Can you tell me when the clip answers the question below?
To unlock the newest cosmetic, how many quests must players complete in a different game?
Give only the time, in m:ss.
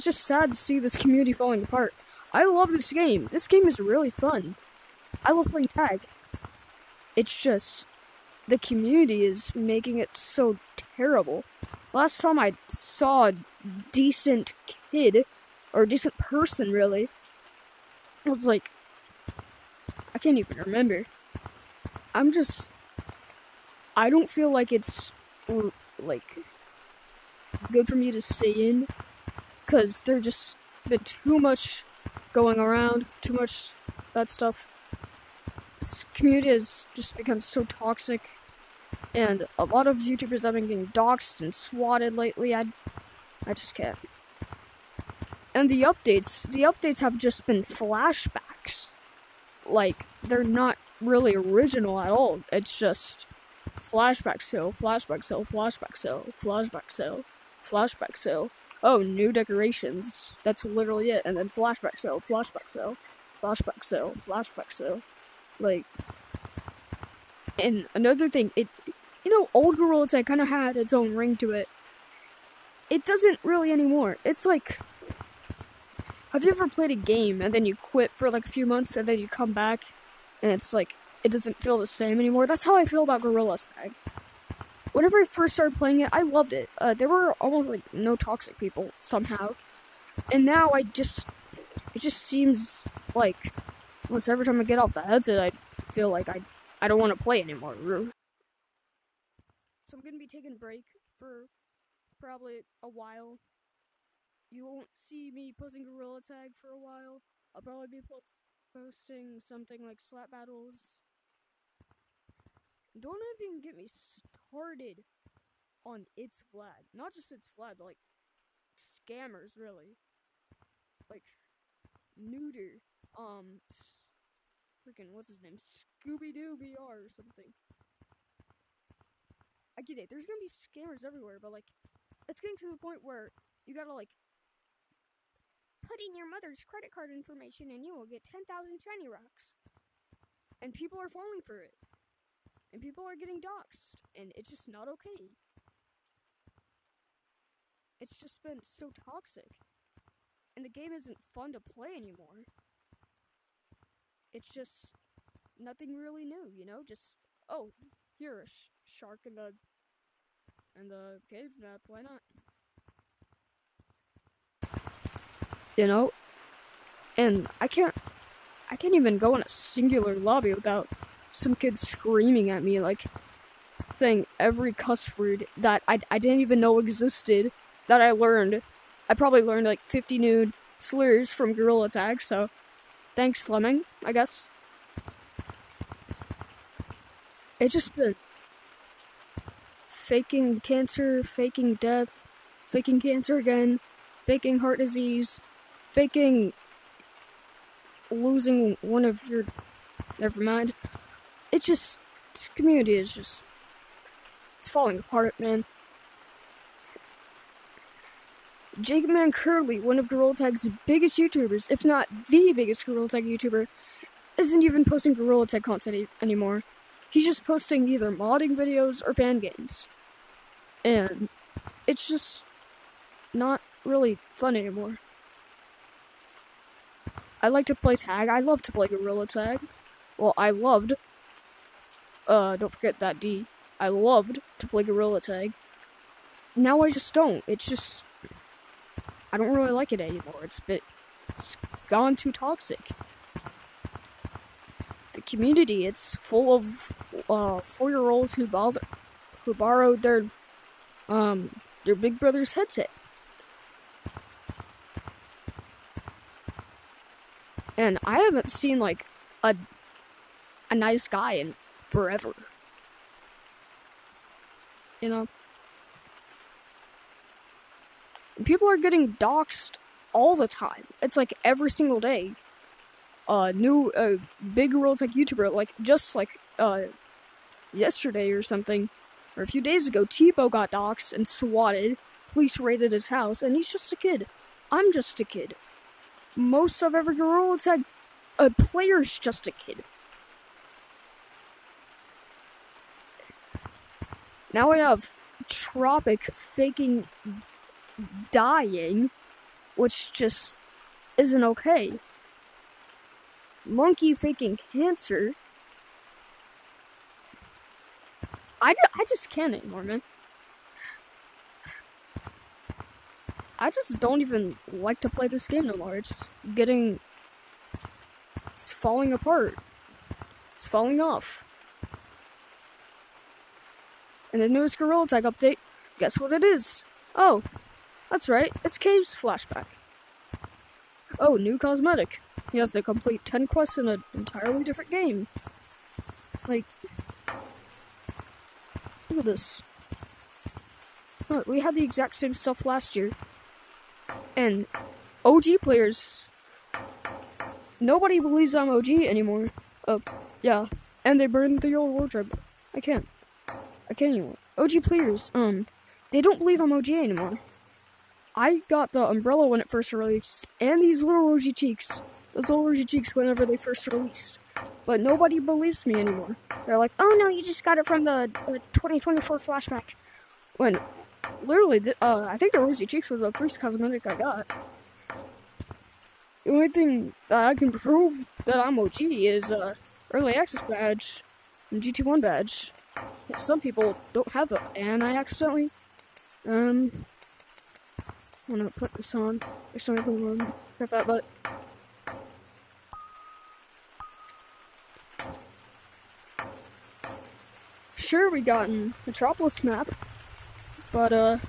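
5:33.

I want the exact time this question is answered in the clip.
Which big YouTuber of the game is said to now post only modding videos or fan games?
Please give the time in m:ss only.
3:28.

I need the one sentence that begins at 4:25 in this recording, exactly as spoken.
You know people are getting doxxed all the time.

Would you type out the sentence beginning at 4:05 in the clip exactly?
The community it's full of uh, four-year-olds who bother, who borrowed their um their Big Brother's headset.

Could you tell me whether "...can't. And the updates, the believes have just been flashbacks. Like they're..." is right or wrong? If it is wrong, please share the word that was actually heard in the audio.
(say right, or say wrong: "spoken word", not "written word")
wrong: "updates", not "believes".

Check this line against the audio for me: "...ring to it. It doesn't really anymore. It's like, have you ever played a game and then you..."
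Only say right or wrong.
right.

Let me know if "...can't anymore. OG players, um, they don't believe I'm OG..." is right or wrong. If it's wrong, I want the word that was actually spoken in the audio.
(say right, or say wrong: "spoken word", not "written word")
right.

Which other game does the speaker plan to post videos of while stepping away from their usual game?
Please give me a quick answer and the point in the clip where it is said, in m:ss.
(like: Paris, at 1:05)
Slap Battles, at 1:49.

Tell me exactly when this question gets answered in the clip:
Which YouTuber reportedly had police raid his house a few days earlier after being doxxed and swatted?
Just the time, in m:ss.
4:40.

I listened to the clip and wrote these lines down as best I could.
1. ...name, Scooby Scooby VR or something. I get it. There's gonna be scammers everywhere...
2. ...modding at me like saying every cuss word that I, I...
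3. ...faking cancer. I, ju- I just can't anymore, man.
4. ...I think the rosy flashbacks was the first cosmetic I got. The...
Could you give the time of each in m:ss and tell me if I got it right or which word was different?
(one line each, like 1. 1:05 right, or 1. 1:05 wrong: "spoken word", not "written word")
1. 2:05 wrong: "Doo", not "Scooby"
2. 2:51 wrong: "screaming", not "modding"
3. 5:04 right
4. 6:12 wrong: "cheeks", not "flashbacks".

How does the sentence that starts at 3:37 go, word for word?
He's just posting either modding videos or fan games.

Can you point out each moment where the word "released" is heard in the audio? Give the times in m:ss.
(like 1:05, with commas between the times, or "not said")
5:59, 6:03.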